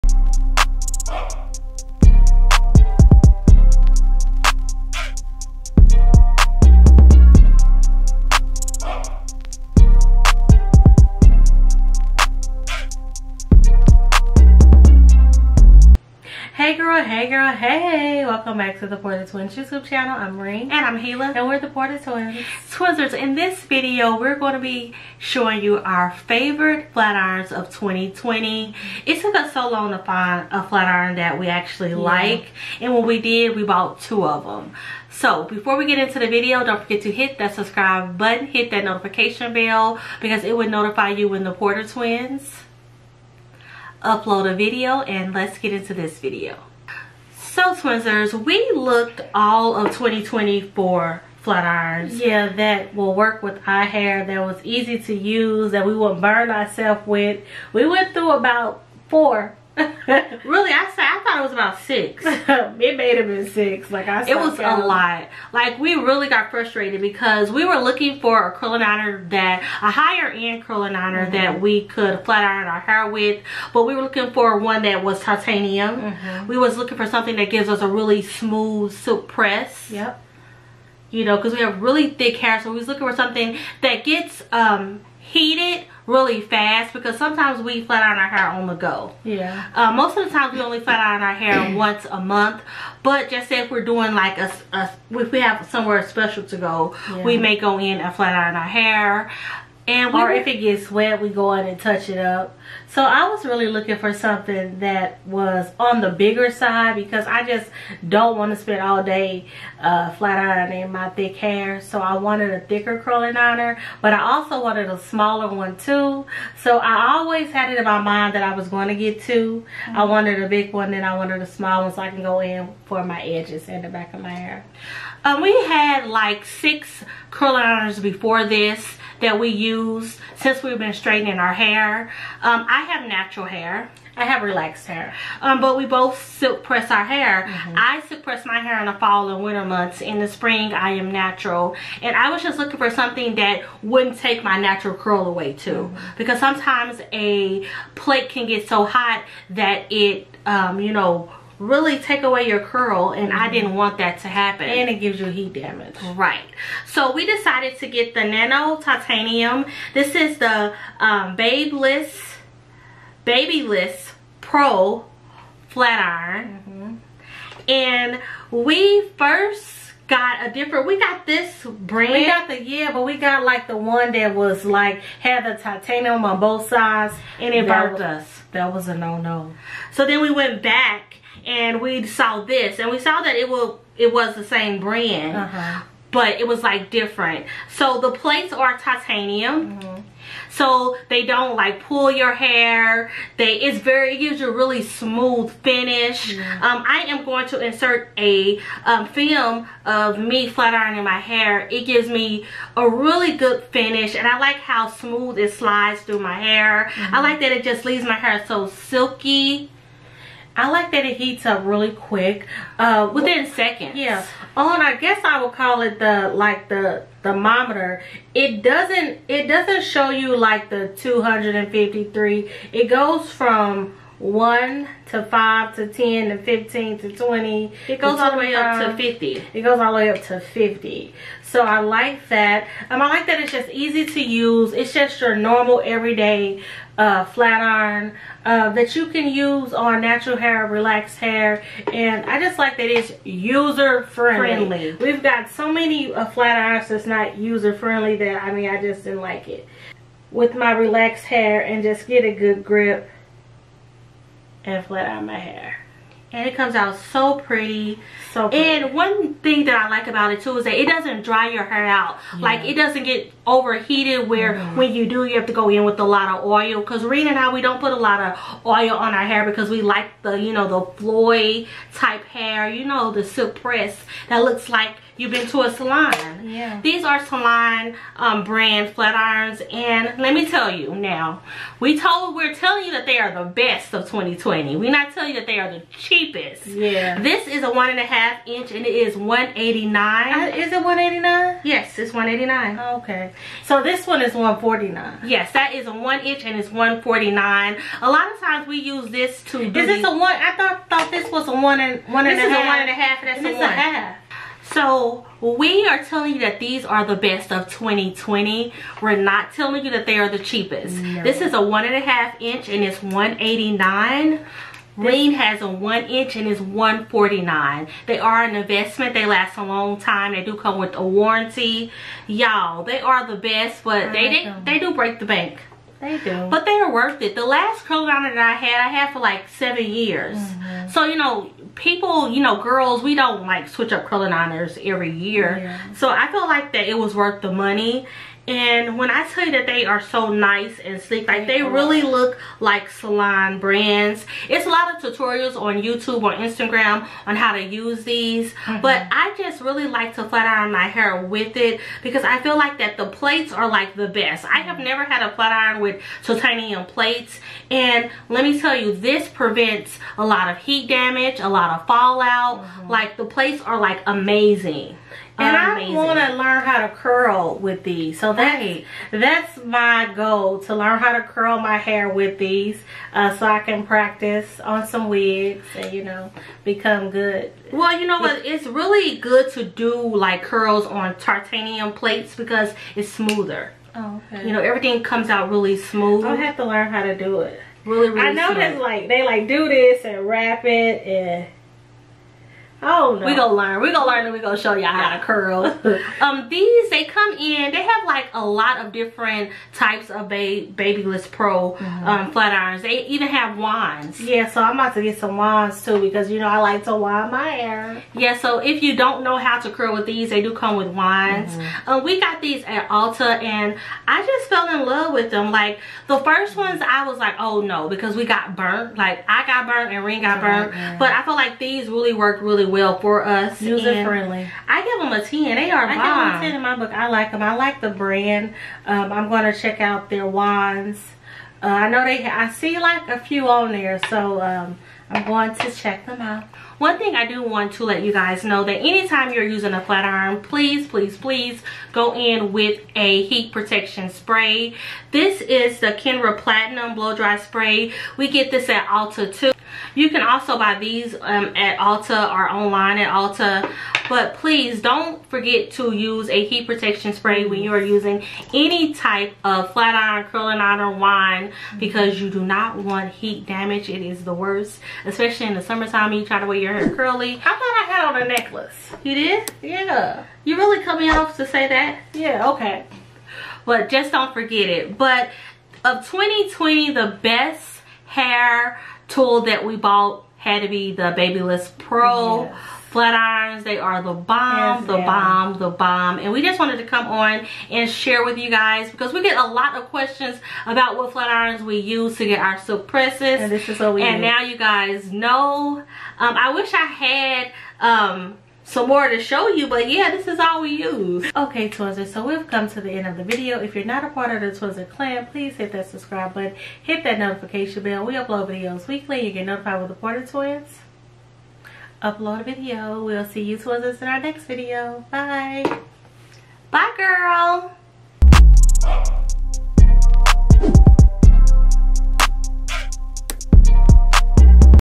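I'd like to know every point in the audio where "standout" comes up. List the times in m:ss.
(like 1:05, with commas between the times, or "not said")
not said.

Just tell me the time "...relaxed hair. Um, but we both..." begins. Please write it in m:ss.
2:14.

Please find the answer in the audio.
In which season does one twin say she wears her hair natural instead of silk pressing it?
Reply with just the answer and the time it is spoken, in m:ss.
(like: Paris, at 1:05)
spring, at 2:20.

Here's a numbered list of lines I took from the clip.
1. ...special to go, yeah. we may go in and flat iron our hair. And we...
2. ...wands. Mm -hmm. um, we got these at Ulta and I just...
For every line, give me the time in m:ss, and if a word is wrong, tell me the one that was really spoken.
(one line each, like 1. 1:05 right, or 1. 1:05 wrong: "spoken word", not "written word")
1. 1:36 right
2. 6:50 right.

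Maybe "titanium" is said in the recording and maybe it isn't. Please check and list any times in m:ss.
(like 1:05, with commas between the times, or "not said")
1:15, 2:38, 2:55, 3:08, 5:56, 6:21.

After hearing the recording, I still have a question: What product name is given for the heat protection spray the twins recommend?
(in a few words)
Kenra Platinum Blow Dry Spray.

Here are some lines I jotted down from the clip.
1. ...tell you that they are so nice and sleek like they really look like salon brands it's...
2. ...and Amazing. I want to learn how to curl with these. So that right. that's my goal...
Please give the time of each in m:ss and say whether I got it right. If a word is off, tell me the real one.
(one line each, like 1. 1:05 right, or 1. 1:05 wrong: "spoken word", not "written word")
1. 5:39 right
2. 6:05 right.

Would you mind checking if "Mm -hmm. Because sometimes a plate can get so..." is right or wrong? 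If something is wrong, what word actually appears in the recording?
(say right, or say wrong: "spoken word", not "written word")
right.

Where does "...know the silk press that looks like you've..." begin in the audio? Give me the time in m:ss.
4:32.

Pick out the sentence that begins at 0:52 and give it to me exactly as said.
Yeah, that will work with our hair, that was easy to use, that we won't burn ourselves with.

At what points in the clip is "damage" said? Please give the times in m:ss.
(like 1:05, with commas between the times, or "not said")
2:35, 6:00, 7:43.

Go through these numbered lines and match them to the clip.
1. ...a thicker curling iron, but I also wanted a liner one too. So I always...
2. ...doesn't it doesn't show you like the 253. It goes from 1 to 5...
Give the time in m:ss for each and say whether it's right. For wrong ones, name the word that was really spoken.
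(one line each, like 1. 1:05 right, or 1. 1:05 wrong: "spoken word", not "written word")
1. 1:52 wrong: "smaller", not "liner"
2. 3:38 right.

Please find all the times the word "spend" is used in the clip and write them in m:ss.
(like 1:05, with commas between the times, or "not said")
1:48.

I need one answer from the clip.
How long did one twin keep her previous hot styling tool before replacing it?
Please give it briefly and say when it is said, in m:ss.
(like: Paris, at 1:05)
seven years, at 5:29.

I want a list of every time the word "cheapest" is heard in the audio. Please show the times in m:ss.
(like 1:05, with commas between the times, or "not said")
4:45, 5:10.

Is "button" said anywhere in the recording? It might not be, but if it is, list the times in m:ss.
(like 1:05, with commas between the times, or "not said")
0:38, 8:26.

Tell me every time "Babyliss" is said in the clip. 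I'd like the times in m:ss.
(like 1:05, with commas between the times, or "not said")
2:43, 6:40, 8:01.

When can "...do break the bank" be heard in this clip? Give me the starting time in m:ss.
5:24.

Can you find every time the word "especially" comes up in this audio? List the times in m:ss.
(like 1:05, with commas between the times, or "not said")
7:45.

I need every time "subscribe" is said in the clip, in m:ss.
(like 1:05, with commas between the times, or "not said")
0:37, 8:25.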